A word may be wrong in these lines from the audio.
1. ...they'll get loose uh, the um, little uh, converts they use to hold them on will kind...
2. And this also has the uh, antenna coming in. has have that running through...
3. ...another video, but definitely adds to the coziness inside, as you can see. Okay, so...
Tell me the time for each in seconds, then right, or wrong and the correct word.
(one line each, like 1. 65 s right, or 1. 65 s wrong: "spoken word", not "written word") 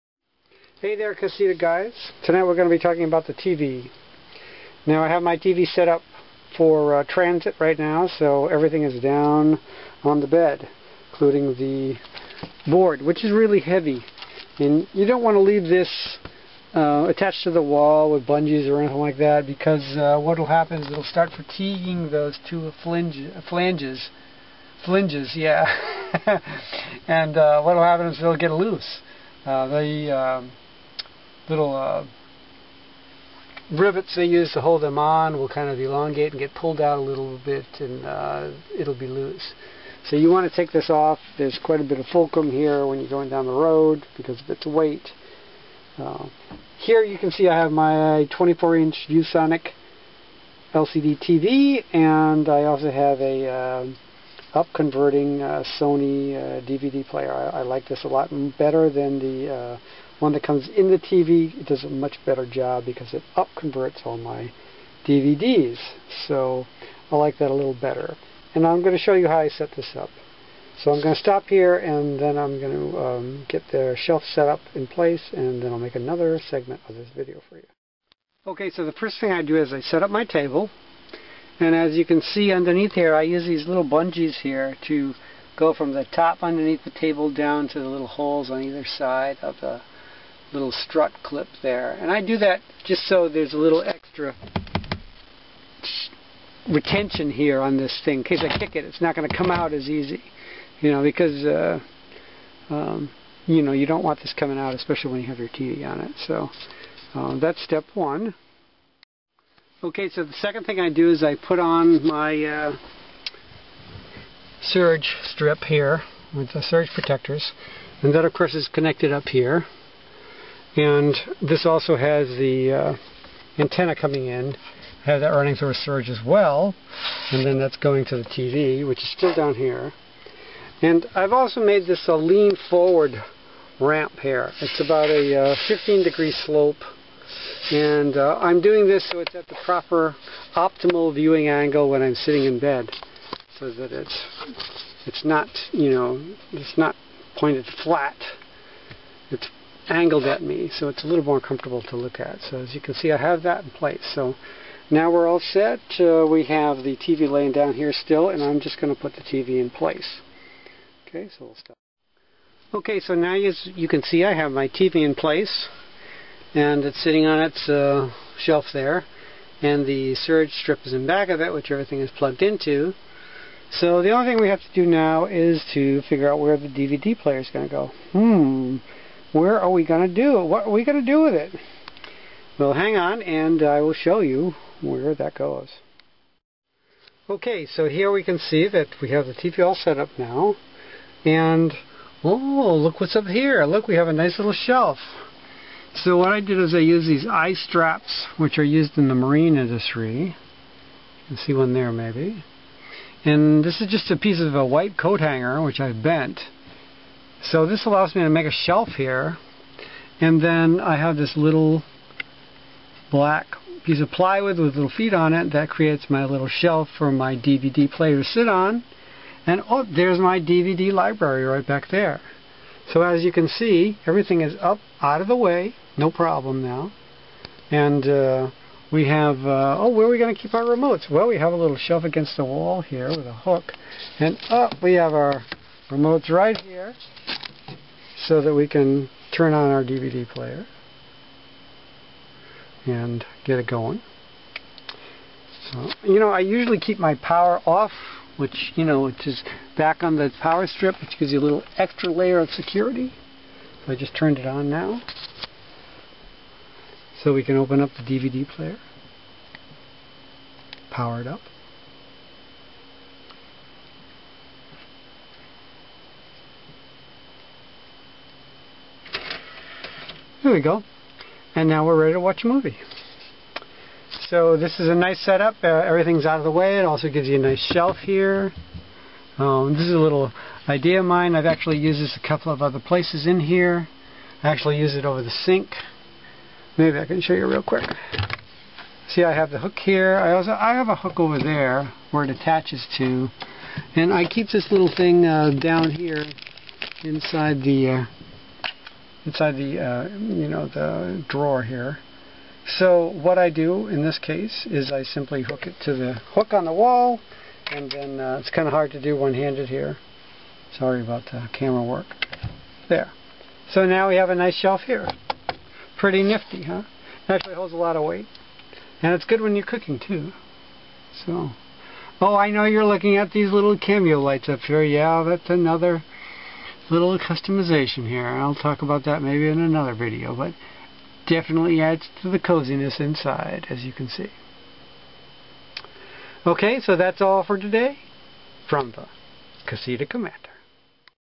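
1. 28 s wrong: "rivets", not "converts"
2. 120 s right
3. 329 s right.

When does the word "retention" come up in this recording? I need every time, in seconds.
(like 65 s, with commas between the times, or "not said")
96 s.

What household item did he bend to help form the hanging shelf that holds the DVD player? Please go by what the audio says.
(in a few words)
A white coat hanger.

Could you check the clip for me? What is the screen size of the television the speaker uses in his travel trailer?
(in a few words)
24-inch.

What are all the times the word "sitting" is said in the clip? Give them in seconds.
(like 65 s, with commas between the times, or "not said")
142 s, 167 s.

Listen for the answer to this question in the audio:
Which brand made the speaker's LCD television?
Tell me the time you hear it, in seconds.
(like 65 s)
49 s.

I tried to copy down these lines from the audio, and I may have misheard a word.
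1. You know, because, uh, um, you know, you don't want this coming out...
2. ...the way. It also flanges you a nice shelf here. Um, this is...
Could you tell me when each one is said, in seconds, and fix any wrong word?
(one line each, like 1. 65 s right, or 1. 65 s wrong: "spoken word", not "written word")
1. 100 s right
2. 276 s wrong: "gives", not "flanges".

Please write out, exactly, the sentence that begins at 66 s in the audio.
So I like that a little better.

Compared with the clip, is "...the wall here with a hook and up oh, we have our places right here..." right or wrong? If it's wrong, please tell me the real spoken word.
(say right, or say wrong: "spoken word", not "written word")
wrong: "remotes", not "places".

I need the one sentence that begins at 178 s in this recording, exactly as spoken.
Hmm where are we going to do it?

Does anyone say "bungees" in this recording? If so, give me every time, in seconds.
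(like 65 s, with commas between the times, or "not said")
18 s, 83 s.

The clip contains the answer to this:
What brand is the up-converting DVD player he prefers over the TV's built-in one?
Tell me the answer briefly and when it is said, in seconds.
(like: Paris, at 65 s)
Sony, at 55 s.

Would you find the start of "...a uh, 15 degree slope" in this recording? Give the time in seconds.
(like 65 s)
135 s.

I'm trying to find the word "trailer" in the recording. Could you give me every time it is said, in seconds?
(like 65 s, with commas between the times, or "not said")
not said.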